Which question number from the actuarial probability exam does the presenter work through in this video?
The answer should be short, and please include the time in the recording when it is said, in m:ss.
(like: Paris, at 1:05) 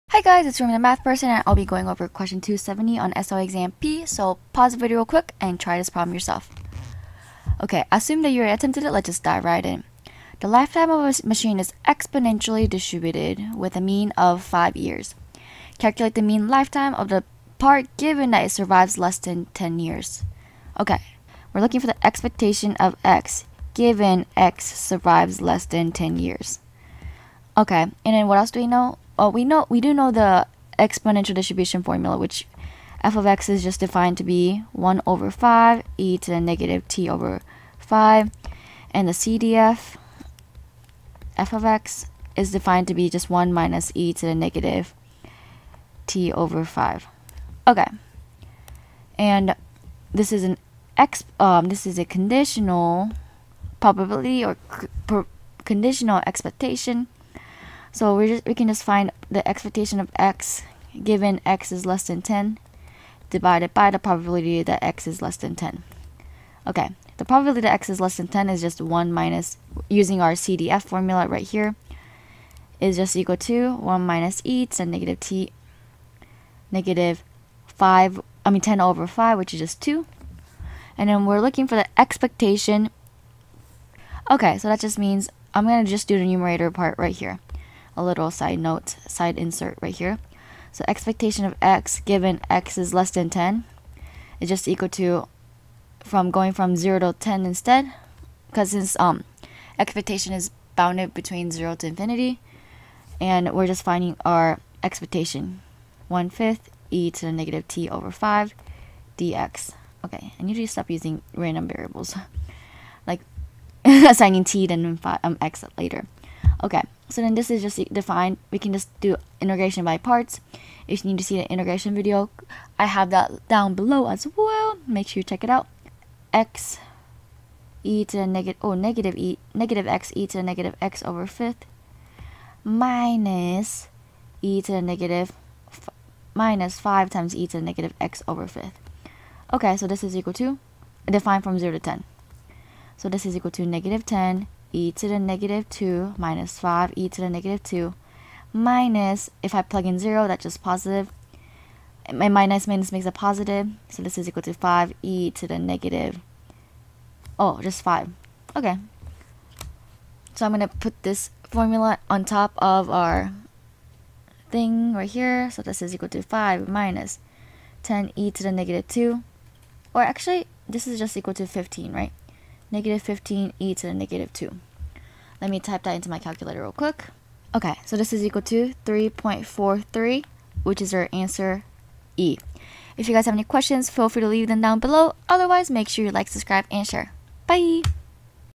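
270, at 0:02.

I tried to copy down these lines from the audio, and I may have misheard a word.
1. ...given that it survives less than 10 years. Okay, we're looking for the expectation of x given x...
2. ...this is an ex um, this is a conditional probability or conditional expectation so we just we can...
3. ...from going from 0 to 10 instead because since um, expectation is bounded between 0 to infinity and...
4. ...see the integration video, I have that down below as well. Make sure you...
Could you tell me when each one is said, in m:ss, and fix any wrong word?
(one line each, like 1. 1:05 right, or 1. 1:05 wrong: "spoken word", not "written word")
1. 0:17 right
2. 0:50 right
3. 1:35 right
4. 2:01 right.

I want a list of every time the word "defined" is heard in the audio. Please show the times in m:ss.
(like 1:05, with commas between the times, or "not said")
0:33, 0:42, 1:57, 2:21.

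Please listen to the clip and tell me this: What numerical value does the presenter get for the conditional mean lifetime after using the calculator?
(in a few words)
3.43.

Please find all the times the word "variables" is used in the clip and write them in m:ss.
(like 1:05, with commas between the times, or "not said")
1:51.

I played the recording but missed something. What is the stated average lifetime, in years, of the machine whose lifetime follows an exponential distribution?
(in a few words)
5 years.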